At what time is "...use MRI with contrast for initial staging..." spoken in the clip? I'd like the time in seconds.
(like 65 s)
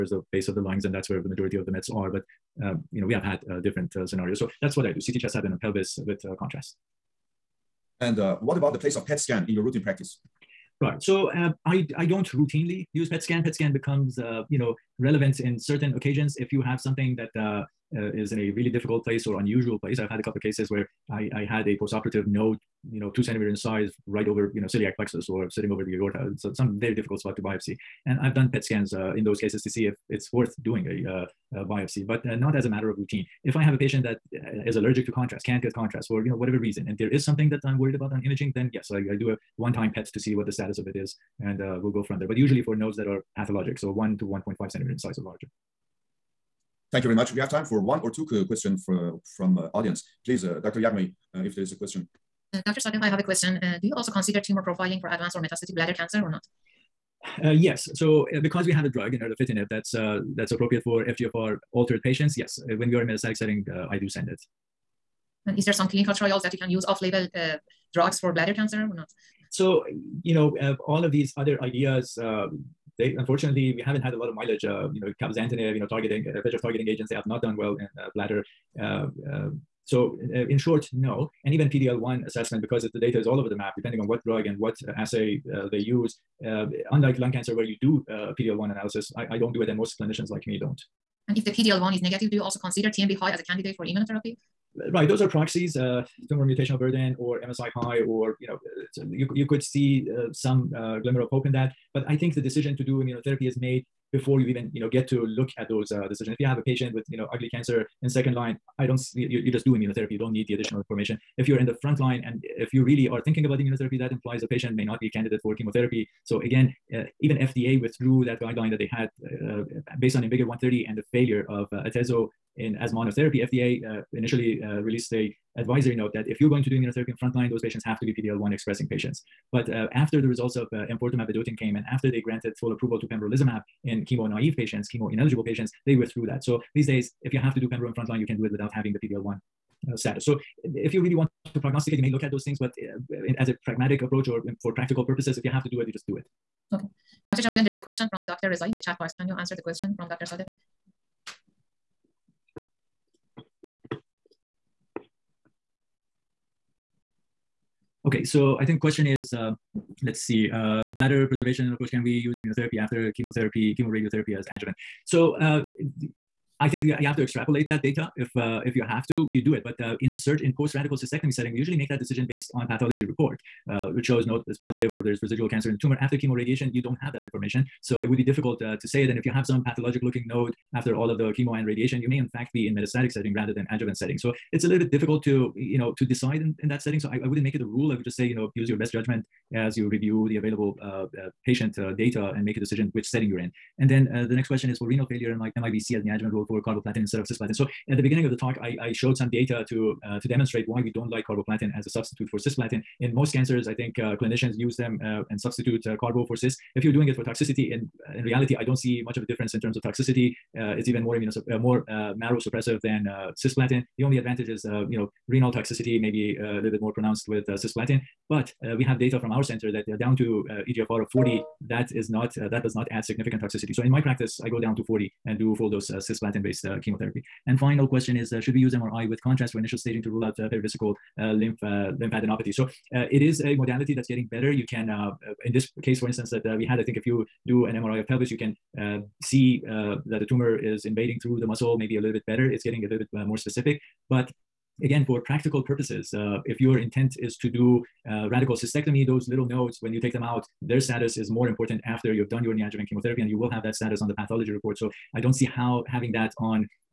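228 s.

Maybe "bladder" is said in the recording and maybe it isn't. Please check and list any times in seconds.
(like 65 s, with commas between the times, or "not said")
55 s, 68 s, 78 s, 160 s.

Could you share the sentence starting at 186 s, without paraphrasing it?
So I, I wouldn't make it a rule.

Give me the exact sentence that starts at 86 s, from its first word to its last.
Uh, unlike lung cancer, where you do uh, PDL1 analysis, I, I don't do it, and most clinicians like me don't.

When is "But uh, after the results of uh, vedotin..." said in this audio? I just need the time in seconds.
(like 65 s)
129 s.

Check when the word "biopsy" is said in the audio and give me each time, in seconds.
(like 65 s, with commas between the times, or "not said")
27 s, 31 s.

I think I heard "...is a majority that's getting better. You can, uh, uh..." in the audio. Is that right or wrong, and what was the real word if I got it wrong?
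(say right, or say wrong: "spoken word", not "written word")
wrong: "modality", not "majority".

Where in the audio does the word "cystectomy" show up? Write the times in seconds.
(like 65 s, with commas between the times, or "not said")
170 s, 248 s.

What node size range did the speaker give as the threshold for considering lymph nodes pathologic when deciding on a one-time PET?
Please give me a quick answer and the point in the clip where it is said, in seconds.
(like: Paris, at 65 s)
1 to 1.5 centimeters, at 43 s.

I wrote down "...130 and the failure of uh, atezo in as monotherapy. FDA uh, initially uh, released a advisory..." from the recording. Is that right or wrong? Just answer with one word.
right.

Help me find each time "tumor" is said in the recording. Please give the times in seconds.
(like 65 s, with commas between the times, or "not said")
54 s, 96 s, 175 s, 240 s.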